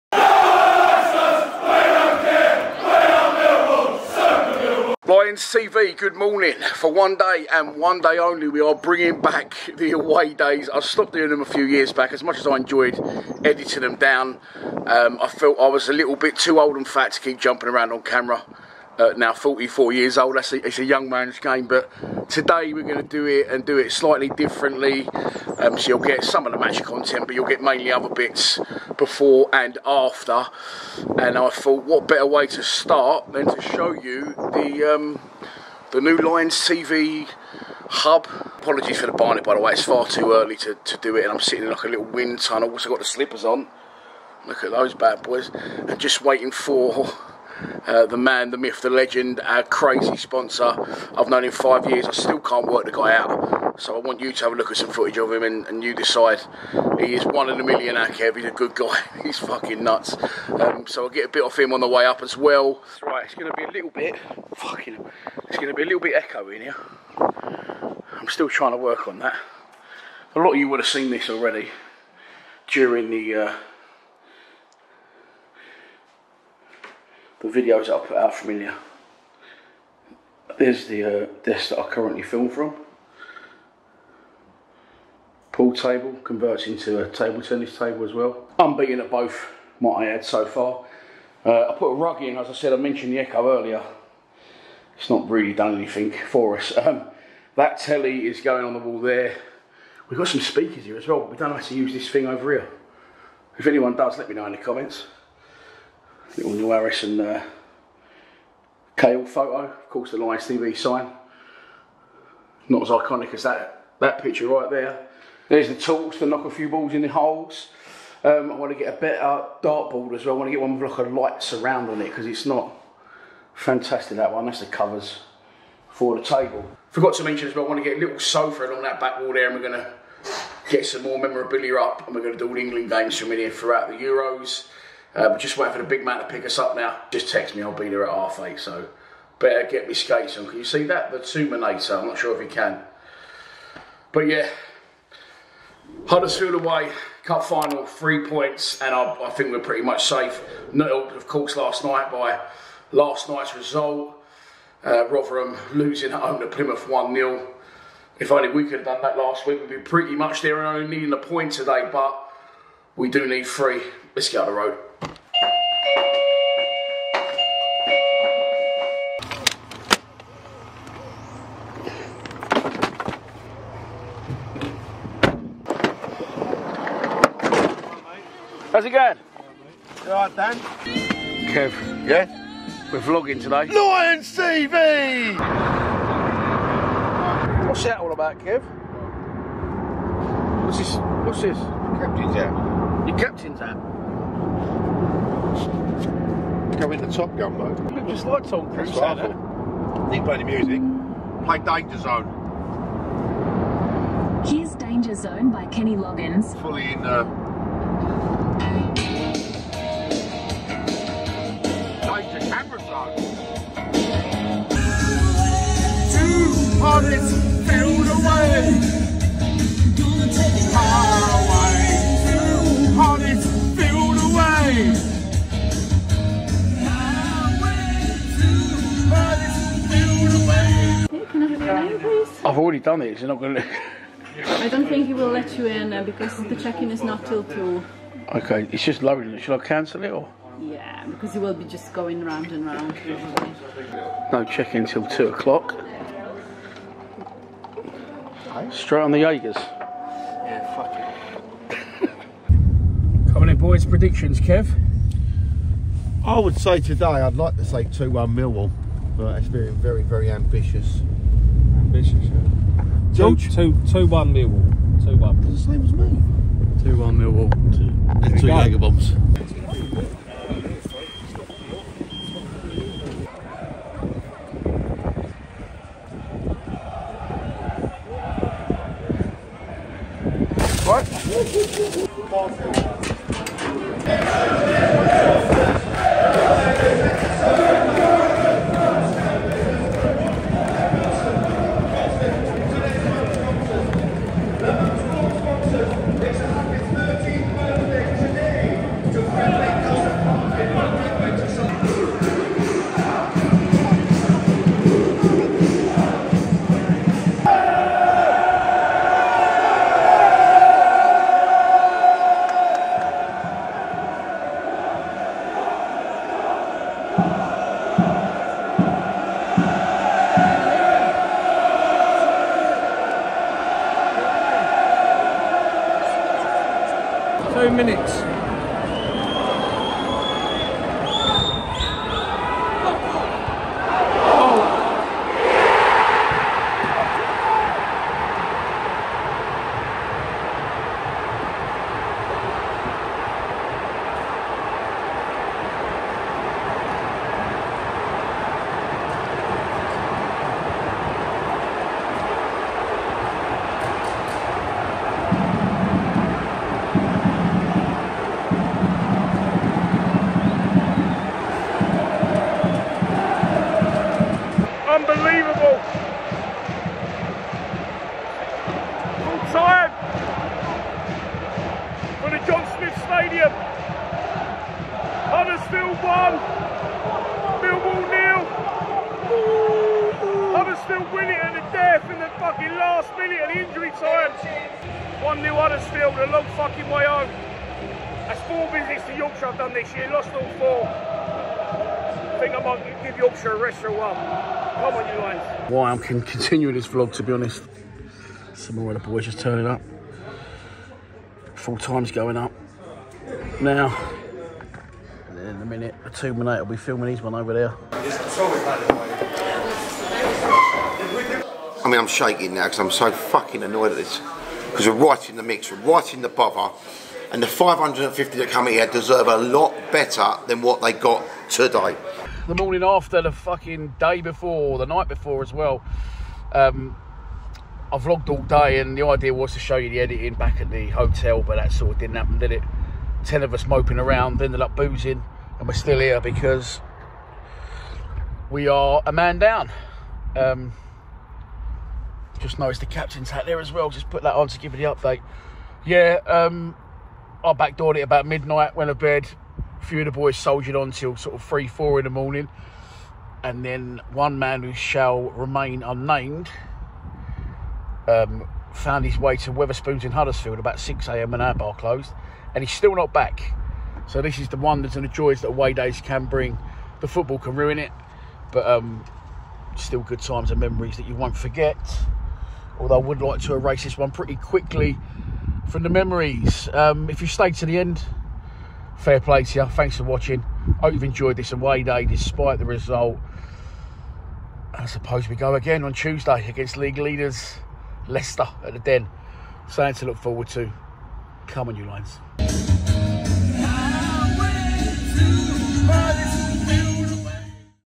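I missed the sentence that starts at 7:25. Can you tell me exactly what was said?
Yeah, um, I backdoored it about midnight, went to bed.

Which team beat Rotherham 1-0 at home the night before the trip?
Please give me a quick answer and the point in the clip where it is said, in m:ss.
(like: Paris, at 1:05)
Plymouth, at 2:36.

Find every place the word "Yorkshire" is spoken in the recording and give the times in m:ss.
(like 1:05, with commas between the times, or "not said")
6:29, 6:33.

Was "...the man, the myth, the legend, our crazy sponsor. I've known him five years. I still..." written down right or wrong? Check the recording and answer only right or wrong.
right.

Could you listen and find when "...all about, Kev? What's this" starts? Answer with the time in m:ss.
3:07.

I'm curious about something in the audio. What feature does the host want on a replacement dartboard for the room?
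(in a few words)
Light surround.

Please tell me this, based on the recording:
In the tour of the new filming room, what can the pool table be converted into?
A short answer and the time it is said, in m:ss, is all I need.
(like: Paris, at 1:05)
Table tennis table, at 1:27.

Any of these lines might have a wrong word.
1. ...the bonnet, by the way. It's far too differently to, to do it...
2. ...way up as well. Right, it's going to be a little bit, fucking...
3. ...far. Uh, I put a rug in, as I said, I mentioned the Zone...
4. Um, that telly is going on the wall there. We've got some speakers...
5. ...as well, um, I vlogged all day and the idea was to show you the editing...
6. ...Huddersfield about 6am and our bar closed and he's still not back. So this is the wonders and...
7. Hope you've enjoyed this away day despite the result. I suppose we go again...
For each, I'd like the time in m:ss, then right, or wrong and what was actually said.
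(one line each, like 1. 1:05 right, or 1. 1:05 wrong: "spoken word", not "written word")
1. 0:39 wrong: "early", not "differently"
2. 1:01 right
3. 1:30 wrong: "Echo", not "Zone"
4. 1:36 right
5. 7:05 right
6. 7:40 right
7. 8:00 right.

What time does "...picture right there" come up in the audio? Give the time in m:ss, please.
1:54.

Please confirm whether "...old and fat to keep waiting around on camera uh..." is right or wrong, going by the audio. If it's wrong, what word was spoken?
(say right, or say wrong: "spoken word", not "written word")
wrong: "jumping", not "waiting".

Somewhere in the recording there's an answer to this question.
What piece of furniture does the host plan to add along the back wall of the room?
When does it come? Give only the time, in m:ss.
2:08.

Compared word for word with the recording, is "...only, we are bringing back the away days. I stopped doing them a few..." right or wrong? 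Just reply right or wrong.
right.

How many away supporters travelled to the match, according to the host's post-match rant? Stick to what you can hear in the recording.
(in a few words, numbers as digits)
550.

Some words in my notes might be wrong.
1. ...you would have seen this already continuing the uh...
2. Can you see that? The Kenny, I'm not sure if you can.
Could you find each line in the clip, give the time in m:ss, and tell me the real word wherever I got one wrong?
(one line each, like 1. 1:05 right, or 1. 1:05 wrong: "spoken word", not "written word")
1. 1:10 wrong: "during", not "continuing"
2. 2:20 wrong: "Tuminator", not "Kenny".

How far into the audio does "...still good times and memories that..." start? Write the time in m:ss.
7:49.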